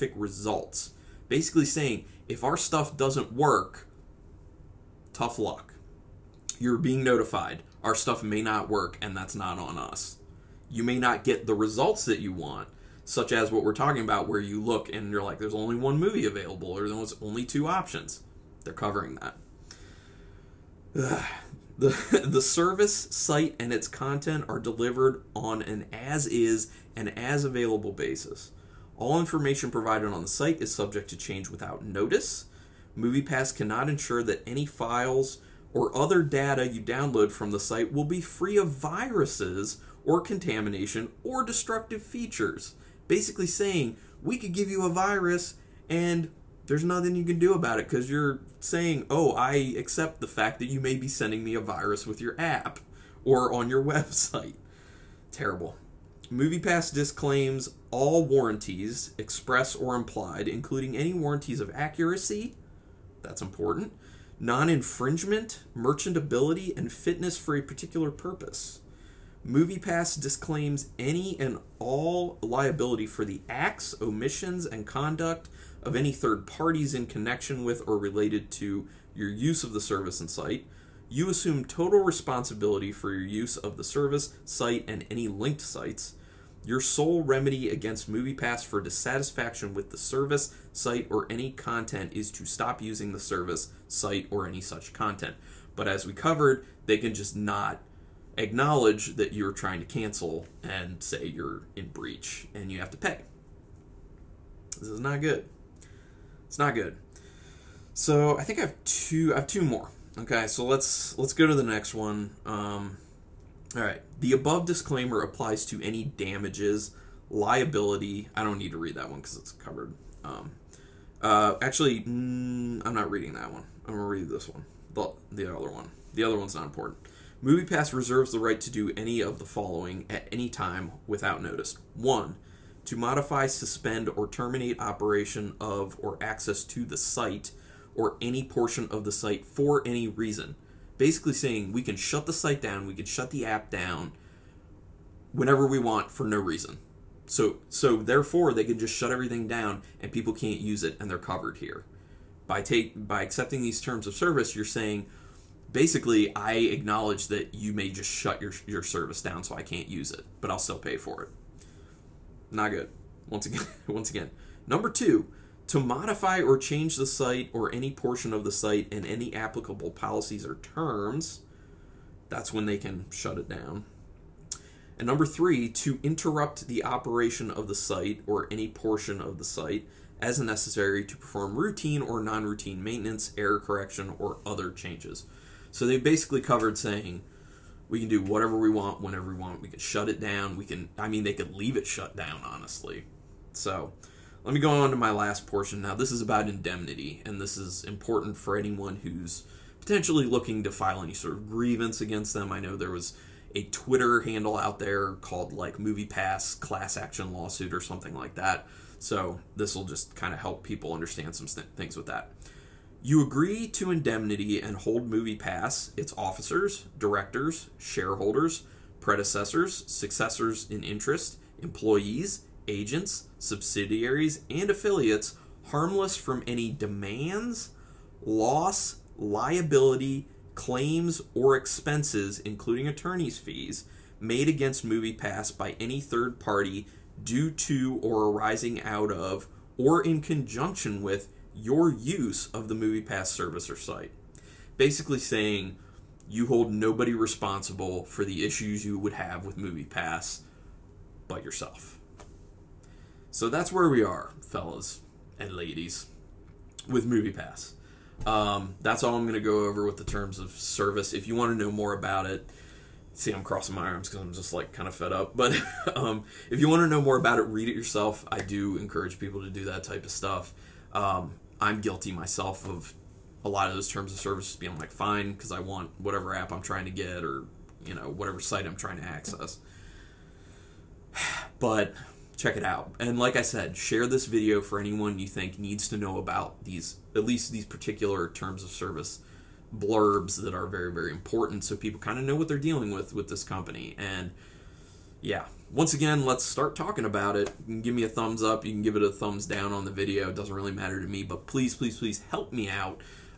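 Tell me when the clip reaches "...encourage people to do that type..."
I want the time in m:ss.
4:28.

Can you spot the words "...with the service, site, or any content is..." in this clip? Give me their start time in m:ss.
1:29.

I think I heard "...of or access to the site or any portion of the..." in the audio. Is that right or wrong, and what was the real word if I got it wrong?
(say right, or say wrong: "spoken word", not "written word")
right.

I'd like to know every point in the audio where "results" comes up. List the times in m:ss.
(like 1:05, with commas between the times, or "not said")
0:00, 0:11.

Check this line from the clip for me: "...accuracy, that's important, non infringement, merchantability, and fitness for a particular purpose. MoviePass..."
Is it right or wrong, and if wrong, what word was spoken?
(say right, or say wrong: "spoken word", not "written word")
right.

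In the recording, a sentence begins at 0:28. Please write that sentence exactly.
All information provided on the site is subject to change without notice.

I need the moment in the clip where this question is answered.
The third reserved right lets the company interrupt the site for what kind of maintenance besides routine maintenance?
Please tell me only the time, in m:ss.
3:02.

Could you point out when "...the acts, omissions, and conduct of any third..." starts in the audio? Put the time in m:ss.
1:13.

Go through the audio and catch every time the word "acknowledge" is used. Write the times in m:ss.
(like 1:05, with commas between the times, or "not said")
1:38, 2:36.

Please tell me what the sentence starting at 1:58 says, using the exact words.
I don't need to read that one because it's covered.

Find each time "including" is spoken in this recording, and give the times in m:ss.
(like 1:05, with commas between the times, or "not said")
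1:00, 3:52.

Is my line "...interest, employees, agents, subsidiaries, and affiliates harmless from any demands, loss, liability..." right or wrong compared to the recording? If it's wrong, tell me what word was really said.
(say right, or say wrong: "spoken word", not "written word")
right.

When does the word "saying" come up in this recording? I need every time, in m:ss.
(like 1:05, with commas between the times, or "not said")
0:01, 0:43, 0:48, 2:21, 2:34, 3:06, 4:05.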